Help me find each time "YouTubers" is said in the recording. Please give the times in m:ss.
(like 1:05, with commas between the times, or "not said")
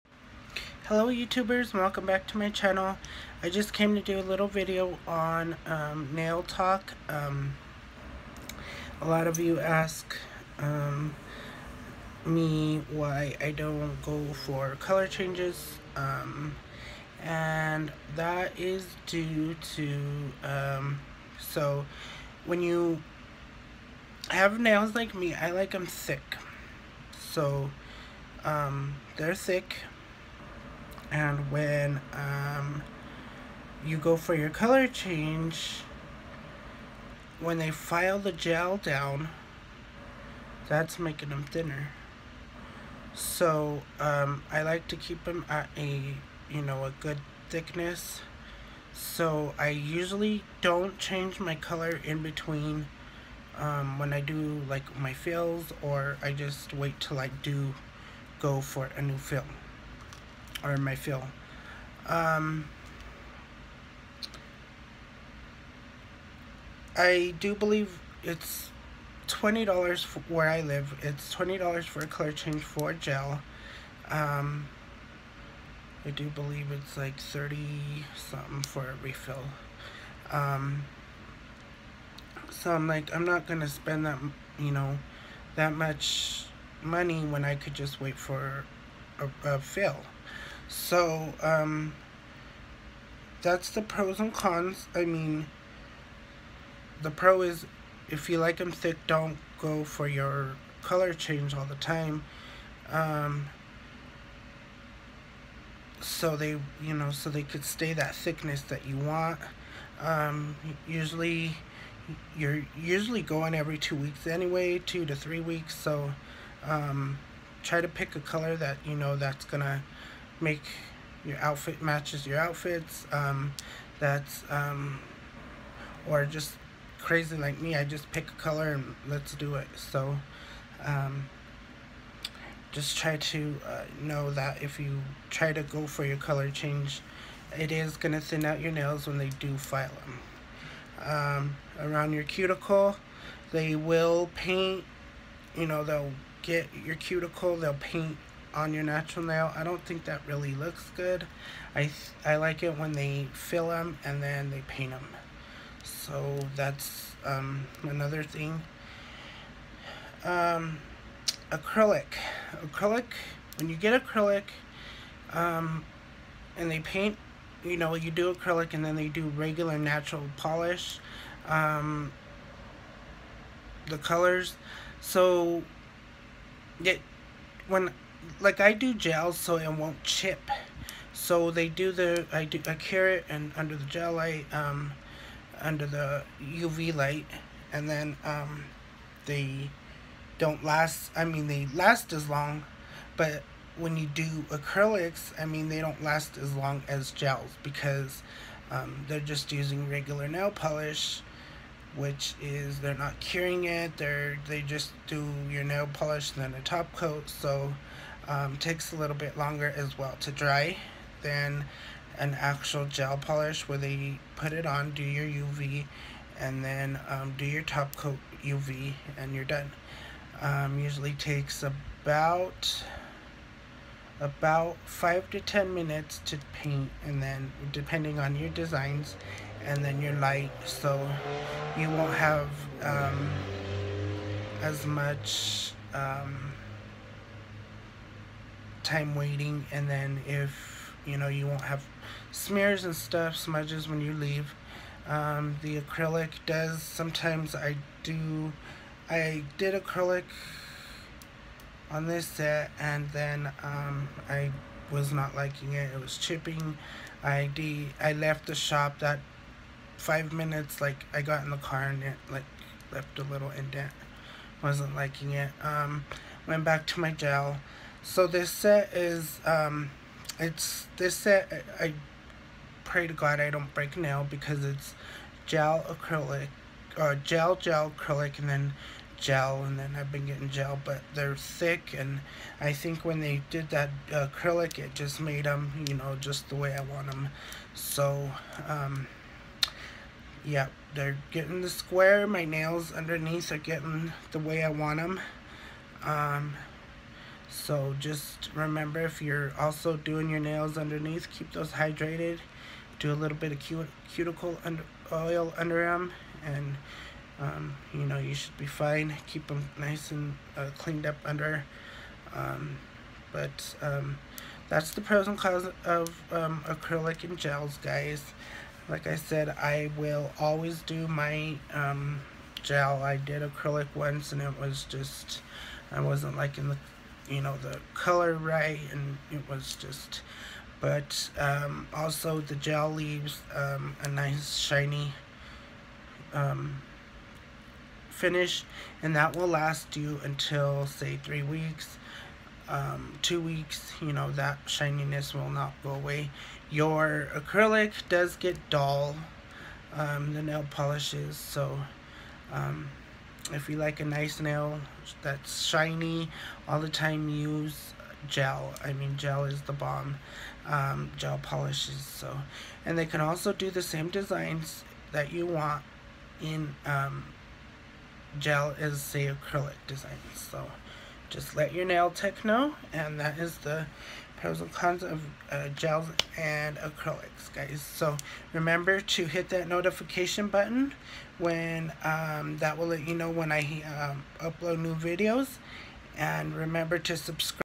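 0:01.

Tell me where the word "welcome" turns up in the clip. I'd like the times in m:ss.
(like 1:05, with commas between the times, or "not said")
0:01.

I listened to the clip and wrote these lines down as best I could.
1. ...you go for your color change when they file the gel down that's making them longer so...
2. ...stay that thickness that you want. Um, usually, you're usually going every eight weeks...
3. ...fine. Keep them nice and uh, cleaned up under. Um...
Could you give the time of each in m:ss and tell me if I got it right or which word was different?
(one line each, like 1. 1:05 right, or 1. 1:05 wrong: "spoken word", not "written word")
1. 0:33 wrong: "thinner", not "longer"
2. 1:47 wrong: "two", not "eight"
3. 5:08 right.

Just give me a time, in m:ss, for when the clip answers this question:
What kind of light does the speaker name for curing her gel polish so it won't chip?
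3:06.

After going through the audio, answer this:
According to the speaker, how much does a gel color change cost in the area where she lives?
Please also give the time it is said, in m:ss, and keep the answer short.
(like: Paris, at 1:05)
$20, at 1:11.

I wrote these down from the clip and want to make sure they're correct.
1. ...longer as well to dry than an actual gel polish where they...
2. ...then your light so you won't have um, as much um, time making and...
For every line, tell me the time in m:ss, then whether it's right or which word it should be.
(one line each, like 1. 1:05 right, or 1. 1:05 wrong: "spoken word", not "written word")
1. 3:29 right
2. 3:49 wrong: "waiting", not "making".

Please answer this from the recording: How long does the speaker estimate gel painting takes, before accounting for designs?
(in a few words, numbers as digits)
5 to 10 minutes.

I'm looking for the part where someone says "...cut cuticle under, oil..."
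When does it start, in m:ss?
5:03.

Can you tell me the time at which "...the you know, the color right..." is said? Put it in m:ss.
5:26.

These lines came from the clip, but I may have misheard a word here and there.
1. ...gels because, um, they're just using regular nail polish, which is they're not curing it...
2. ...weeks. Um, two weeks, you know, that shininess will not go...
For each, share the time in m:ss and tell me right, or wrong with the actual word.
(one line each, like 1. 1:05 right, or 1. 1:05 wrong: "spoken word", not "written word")
1. 3:17 right
2. 5:41 right.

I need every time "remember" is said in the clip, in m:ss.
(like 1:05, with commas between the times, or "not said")
4:58, 6:18, 6:26.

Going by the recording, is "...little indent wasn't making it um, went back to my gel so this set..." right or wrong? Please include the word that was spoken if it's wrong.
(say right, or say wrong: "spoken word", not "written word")
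wrong: "liking", not "making".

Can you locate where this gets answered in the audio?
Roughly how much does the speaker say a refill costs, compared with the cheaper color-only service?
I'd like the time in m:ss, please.
1:17.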